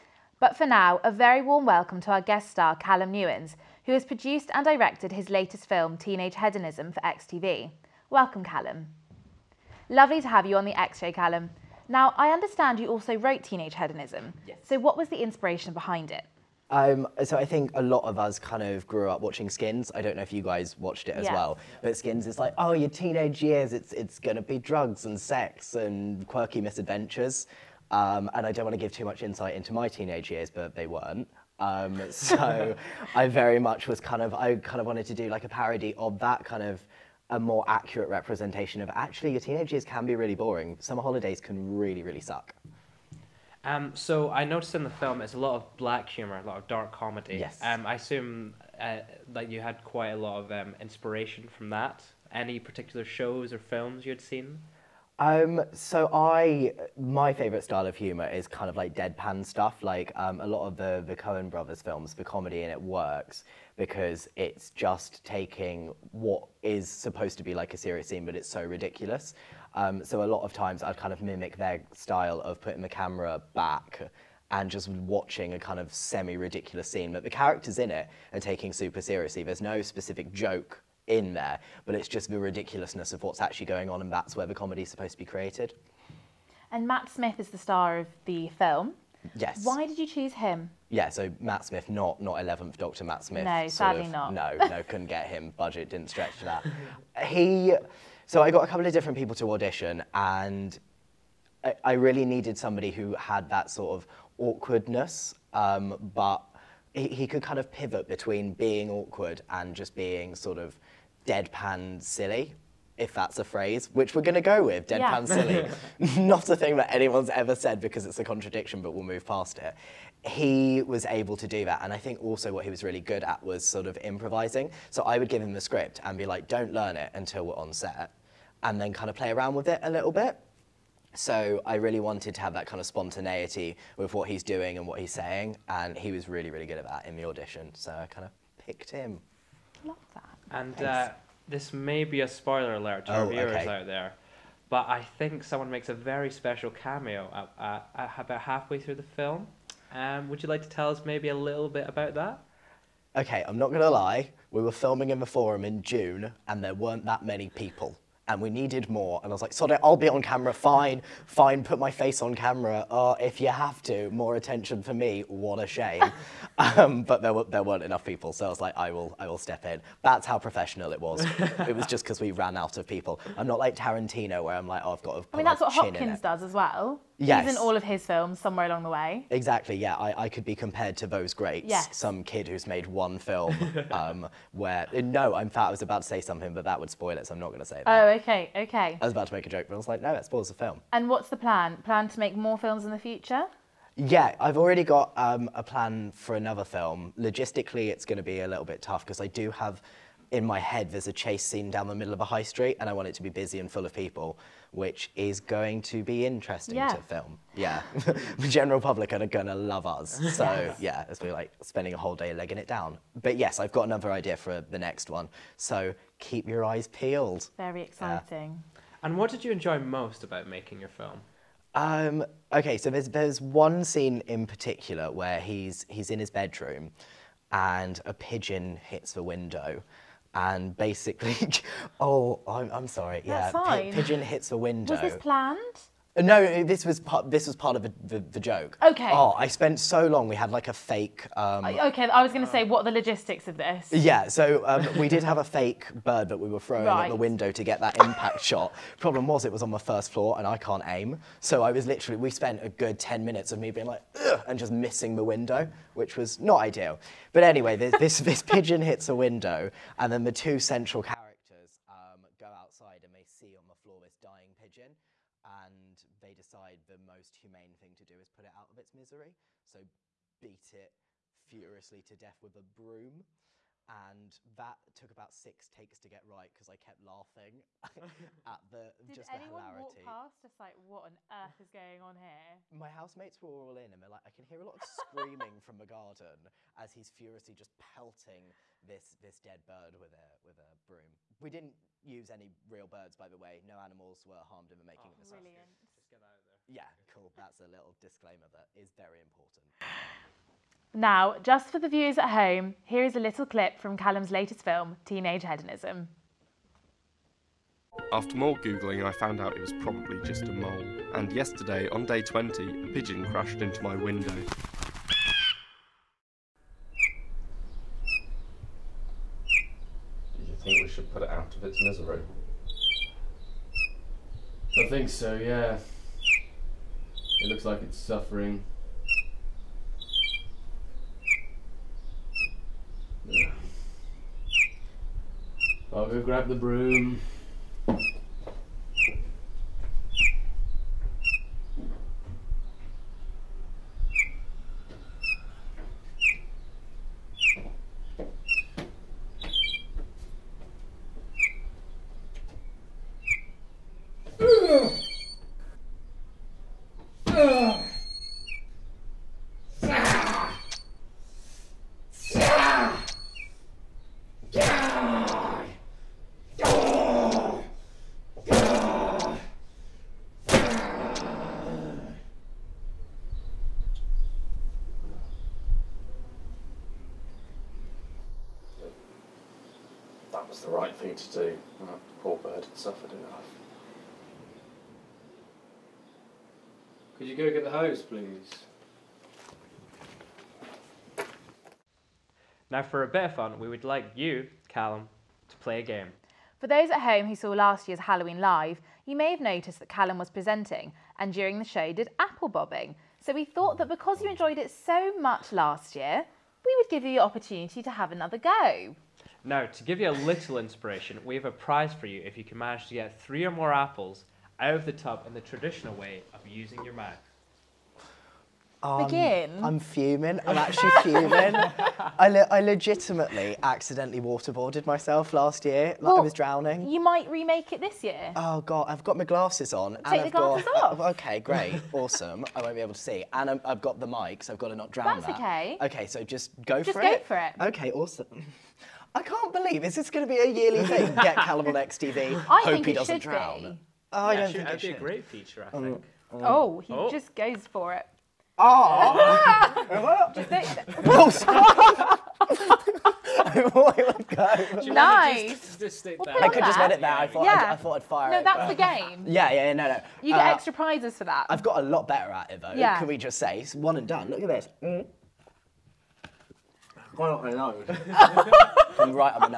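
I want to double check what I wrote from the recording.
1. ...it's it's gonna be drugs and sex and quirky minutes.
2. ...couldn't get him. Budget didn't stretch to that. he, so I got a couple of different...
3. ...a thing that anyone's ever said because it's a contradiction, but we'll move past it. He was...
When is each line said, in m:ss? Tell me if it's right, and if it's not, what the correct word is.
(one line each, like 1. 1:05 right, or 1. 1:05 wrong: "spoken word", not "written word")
1. 0:23 wrong: "misadventures", not "minutes"
2. 1:34 right
3. 1:56 right.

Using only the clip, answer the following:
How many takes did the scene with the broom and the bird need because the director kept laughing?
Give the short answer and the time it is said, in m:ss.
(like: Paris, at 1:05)
6, at 4:35.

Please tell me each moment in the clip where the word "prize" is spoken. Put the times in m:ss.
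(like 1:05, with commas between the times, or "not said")
6:51, 7:40.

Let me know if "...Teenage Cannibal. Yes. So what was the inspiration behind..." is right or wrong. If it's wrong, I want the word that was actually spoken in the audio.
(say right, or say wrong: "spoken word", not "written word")
wrong: "Hedonism", not "Cannibal".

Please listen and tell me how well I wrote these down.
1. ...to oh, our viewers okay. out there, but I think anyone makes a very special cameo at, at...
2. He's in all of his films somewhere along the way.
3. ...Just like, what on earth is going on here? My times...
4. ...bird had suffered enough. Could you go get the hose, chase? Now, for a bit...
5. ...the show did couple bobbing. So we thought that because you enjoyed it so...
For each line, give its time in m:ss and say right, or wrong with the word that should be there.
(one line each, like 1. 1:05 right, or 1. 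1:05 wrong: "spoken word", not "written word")
1. 2:23 wrong: "someone", not "anyone"
2. 2:57 right
3. 4:40 wrong: "housemates", not "times"
4. 6:22 wrong: "please", not "chase"
5. 6:41 wrong: "apple", not "couple".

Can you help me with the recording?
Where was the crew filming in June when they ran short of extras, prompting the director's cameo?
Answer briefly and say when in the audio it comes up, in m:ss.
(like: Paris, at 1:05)
the Forum, at 2:35.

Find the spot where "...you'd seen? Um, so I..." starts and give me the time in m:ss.
0:54.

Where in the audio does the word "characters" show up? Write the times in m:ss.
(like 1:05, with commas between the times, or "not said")
1:17, 4:21.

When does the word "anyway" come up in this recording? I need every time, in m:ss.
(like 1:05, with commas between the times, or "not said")
4:17.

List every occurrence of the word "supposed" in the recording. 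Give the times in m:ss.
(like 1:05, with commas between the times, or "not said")
1:06, 1:24.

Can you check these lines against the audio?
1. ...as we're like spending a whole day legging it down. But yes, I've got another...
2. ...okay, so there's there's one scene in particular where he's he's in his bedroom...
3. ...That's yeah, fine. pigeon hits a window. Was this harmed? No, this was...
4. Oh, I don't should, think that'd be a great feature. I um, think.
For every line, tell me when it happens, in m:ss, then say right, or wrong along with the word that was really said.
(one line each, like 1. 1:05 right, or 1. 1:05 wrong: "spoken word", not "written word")
1. 3:31 right
2. 3:42 right
3. 3:53 wrong: "planned", not "harmed"
4. 7:24 right.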